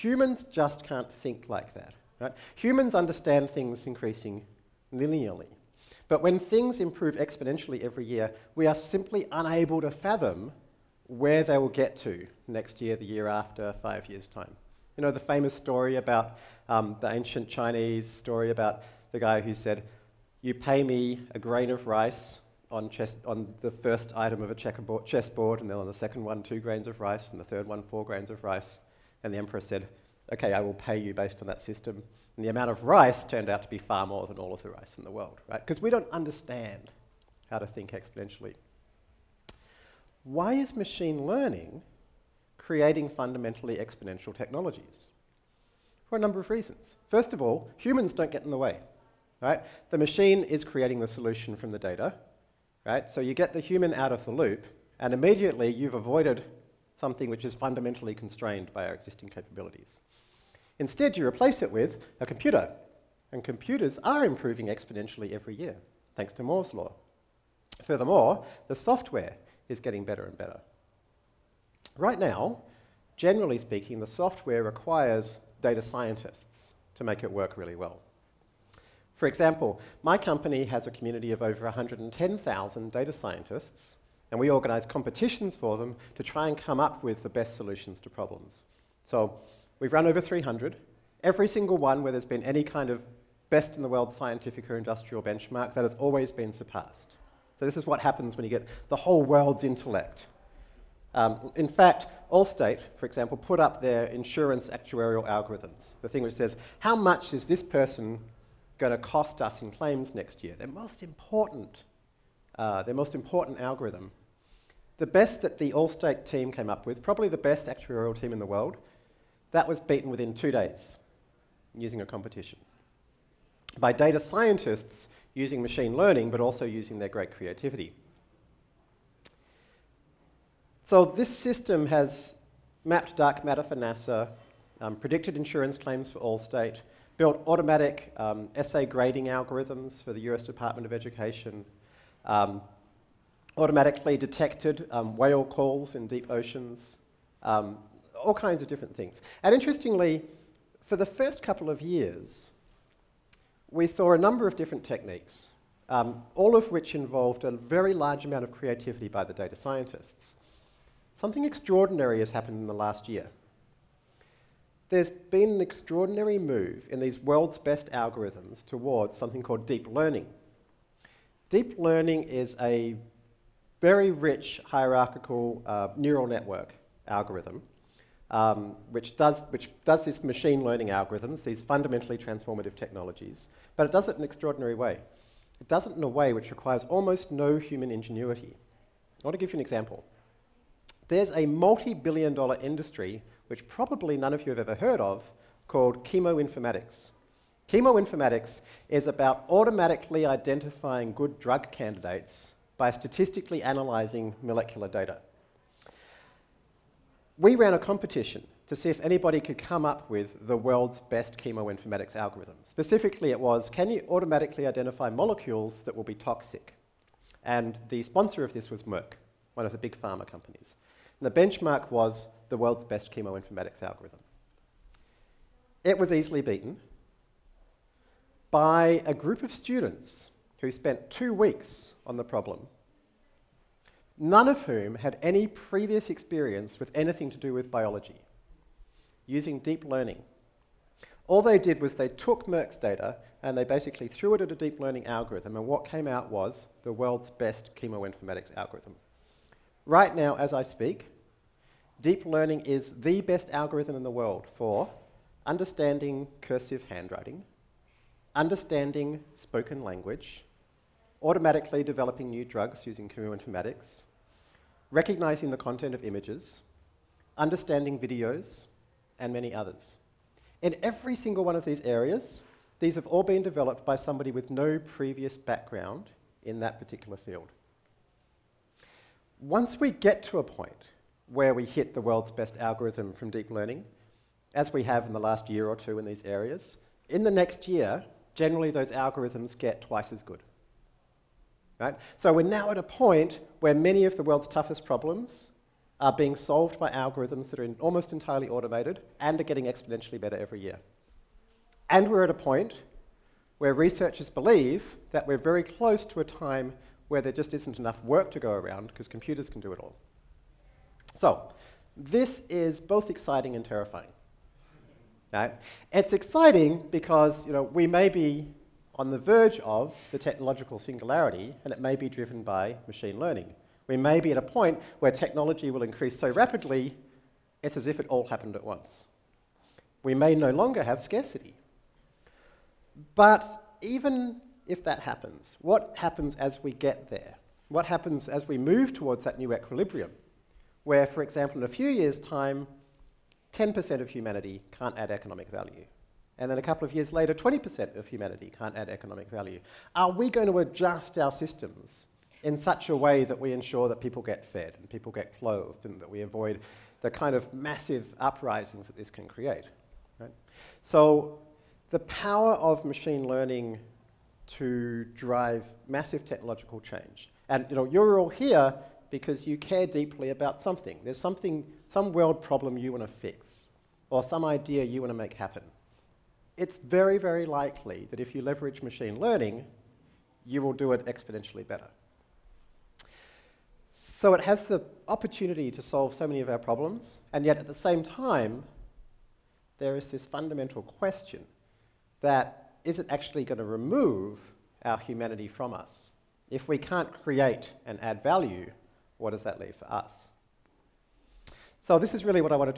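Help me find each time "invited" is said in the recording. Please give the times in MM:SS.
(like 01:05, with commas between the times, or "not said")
not said.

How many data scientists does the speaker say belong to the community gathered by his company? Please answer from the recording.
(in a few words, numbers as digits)
110,000.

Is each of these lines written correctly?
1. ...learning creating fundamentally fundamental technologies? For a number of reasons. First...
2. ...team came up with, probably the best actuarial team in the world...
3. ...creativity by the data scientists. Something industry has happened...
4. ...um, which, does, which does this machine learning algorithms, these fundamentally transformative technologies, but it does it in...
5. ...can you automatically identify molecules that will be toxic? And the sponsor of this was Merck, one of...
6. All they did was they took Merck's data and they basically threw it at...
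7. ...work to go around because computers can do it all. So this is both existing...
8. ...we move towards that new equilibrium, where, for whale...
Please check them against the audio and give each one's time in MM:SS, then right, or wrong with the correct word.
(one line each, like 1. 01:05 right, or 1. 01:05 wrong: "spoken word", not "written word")
1. 00:41 wrong: "exponential", not "fundamental"
2. 01:56 right
3. 02:38 wrong: "extraordinary", not "industry"
4. 02:58 right
5. 03:33 right
6. 04:01 right
7. 05:08 wrong: "exciting", not "existing"
8. 05:38 wrong: "example", not "whale".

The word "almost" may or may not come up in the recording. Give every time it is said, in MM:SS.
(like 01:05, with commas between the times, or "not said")
03:06, 04:57.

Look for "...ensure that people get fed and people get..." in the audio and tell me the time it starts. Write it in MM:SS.
05:53.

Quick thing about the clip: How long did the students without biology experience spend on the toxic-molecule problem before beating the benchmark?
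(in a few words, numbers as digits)
2 weeks.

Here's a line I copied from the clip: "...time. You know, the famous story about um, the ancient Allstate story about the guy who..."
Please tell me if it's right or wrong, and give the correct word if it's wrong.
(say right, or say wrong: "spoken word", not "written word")
wrong: "Chinese", not "Allstate".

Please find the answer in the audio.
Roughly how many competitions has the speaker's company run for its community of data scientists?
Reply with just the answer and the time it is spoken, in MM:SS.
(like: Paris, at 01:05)
over 300, at 01:30.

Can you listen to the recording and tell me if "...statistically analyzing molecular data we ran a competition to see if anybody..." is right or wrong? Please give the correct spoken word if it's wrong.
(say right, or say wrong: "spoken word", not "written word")
right.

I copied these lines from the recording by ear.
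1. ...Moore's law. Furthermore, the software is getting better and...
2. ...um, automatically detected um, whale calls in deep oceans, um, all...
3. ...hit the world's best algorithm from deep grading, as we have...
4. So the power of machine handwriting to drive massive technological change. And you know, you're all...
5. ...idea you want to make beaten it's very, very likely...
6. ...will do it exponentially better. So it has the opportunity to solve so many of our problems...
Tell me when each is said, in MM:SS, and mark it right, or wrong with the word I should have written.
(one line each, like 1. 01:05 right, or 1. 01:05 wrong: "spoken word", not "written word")
1. 01:06 right
2. 02:22 right
3. 04:41 wrong: "learning", not "grading"
4. 06:00 wrong: "learning", not "handwriting"
5. 06:14 wrong: "happen", not "beaten"
6. 06:20 right.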